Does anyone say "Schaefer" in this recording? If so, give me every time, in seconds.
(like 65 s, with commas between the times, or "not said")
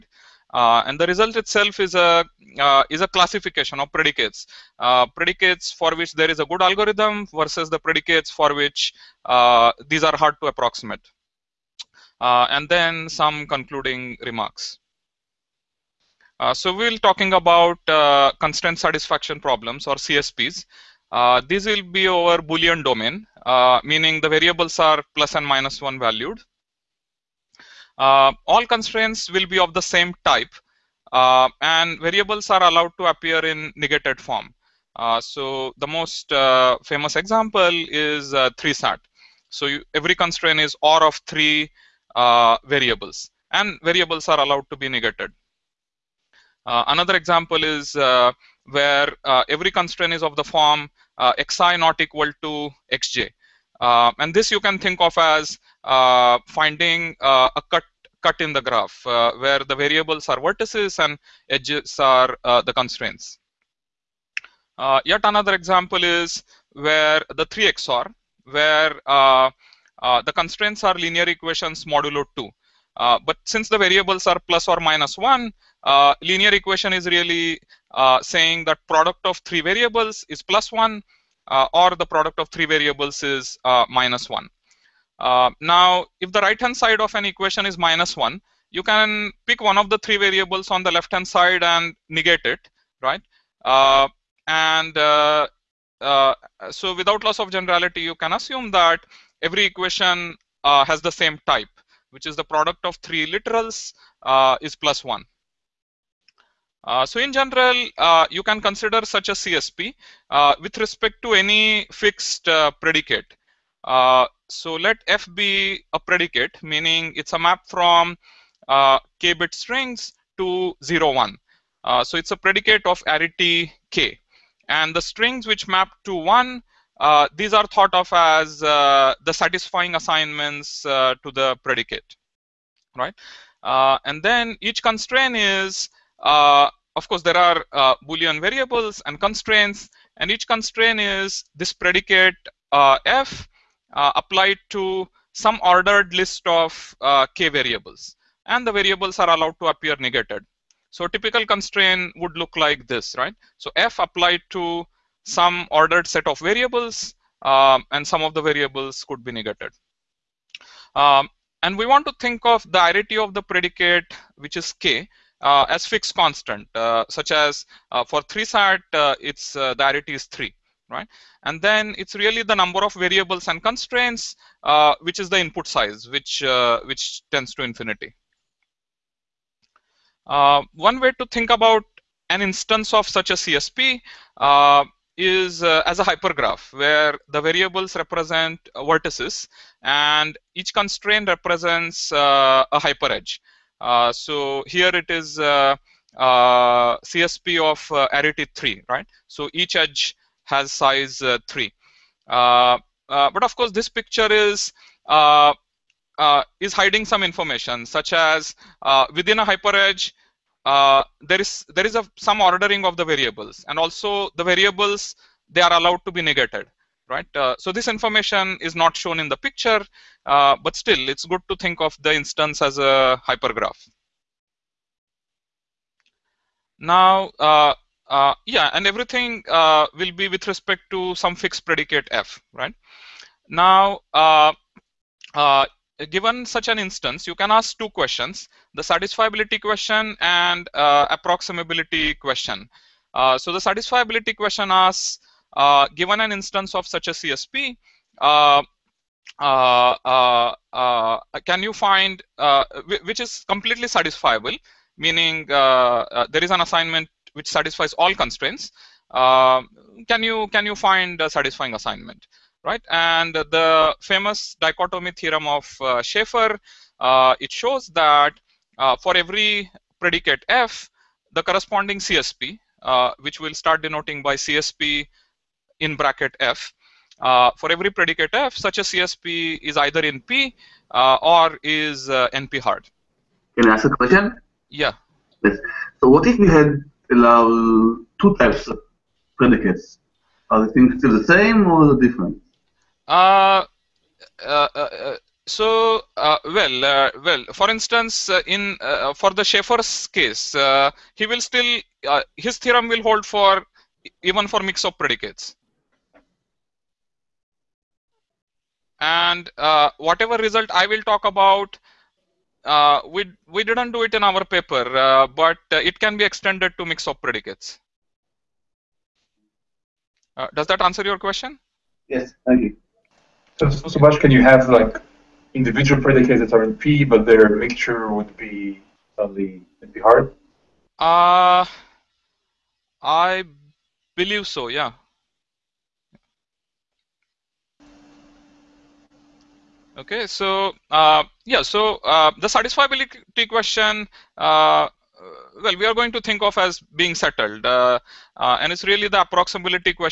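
266 s, 299 s.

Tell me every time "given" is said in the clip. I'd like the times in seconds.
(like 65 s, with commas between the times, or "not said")
236 s, 245 s.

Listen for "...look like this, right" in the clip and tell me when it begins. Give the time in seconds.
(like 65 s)
152 s.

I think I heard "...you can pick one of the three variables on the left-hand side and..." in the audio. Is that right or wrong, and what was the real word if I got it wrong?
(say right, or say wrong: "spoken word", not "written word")
right.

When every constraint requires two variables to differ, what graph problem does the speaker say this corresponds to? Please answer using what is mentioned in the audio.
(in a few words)
cut.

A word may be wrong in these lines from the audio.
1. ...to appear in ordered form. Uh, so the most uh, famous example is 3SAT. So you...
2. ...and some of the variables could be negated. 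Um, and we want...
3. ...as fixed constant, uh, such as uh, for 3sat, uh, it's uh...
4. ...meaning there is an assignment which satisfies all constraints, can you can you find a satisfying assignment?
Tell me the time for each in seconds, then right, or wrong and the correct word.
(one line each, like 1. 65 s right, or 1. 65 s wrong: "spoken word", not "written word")
1. 32 s wrong: "negated", not "ordered"
2. 157 s right
3. 165 s right
4. 254 s right.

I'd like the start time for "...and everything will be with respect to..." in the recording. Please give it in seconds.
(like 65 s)
228 s.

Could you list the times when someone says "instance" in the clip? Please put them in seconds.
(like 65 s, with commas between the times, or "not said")
182 s, 222 s, 236 s, 246 s, 297 s.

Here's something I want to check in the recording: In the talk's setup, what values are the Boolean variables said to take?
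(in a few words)
plus and minus one.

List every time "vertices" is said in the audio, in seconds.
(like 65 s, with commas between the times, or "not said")
60 s, 188 s.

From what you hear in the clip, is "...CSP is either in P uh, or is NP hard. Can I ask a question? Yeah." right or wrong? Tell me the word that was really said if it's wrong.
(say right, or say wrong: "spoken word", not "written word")
right.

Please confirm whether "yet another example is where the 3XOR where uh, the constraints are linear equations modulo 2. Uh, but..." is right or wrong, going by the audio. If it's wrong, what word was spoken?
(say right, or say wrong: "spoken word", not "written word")
right.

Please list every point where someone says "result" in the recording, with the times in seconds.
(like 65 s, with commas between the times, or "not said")
1 s, 310 s.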